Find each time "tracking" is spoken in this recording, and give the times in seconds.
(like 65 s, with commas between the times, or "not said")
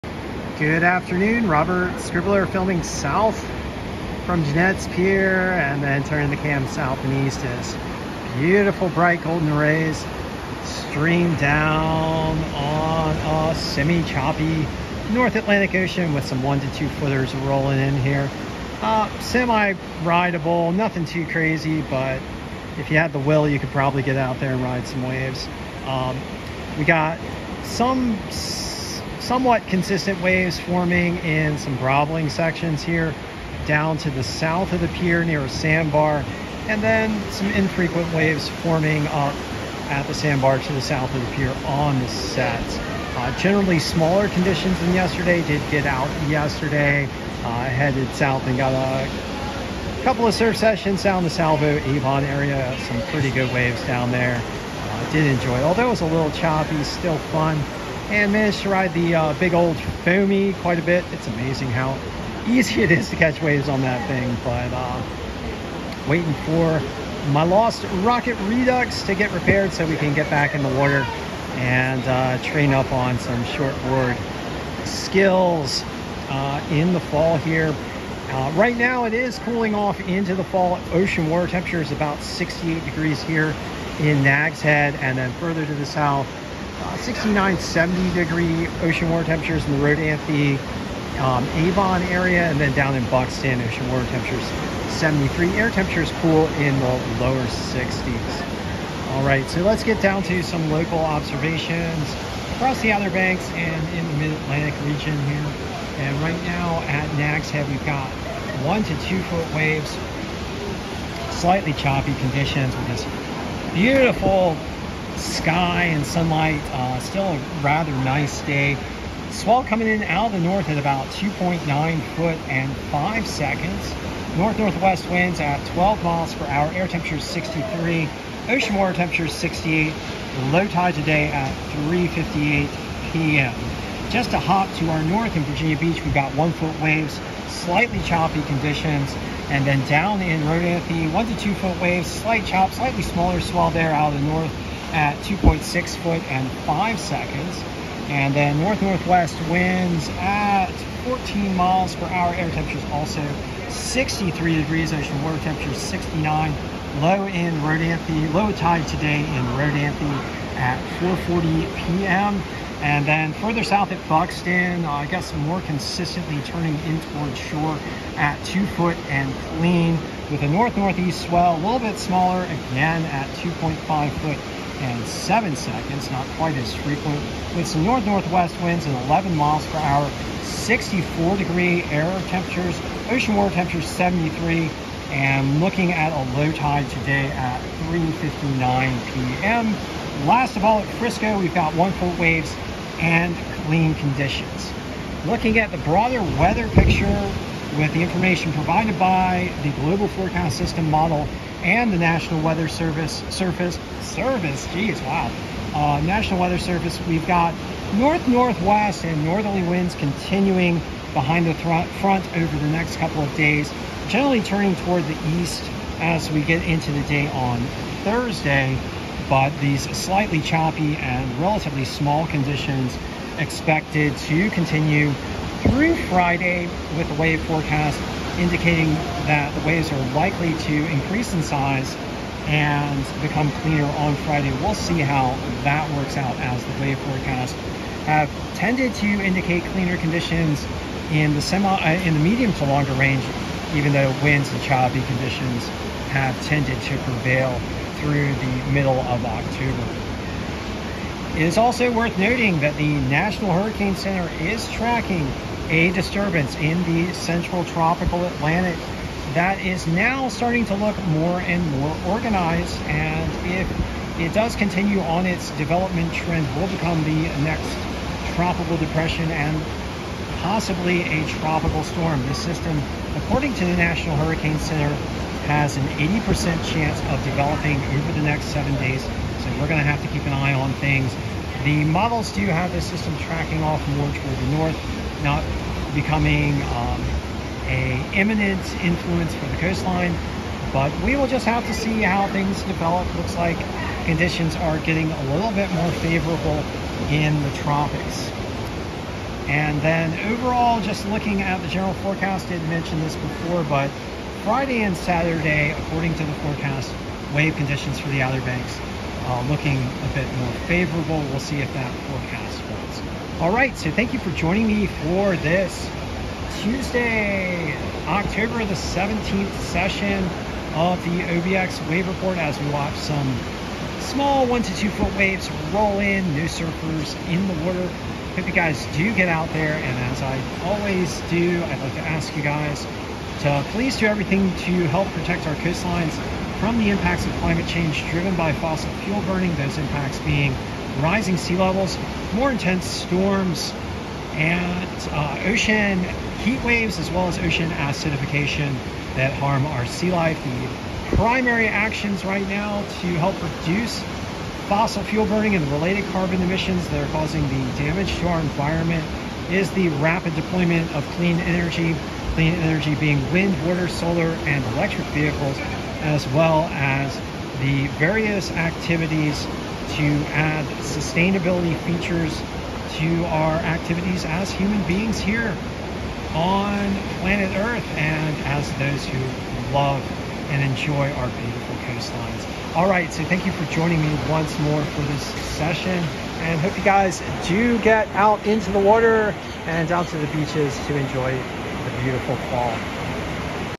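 254 s, 283 s.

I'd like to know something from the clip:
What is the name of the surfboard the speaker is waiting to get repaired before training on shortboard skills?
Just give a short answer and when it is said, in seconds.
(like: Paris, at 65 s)
Lost Rocket Redux, at 67 s.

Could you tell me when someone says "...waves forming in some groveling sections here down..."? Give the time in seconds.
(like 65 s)
30 s.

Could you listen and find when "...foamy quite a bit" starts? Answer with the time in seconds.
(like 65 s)
60 s.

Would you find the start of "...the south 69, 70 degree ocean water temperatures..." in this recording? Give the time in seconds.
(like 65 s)
85 s.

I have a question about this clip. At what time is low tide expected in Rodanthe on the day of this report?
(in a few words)
4:40 p.m.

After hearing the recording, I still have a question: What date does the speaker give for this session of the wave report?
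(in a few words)
Tuesday, October 17.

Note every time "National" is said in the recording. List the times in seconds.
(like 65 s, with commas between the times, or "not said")
201 s, 206 s, 253 s, 273 s.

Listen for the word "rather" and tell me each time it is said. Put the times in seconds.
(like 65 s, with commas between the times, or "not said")
117 s.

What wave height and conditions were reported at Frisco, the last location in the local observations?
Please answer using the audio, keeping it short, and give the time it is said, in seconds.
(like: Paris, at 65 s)
1-foot, clean, at 191 s.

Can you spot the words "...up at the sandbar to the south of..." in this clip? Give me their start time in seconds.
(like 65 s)
39 s.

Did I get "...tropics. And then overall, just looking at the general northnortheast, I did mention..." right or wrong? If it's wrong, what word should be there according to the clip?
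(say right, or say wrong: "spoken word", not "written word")
wrong: "forecast", not "northnortheast".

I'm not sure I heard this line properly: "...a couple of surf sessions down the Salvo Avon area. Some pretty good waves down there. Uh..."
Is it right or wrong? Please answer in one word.
right.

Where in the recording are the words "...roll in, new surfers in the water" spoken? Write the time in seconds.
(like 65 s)
325 s.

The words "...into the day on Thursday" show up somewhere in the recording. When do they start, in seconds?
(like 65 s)
216 s.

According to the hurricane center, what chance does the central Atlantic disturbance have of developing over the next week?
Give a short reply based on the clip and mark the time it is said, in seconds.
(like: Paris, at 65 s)
80%, at 275 s.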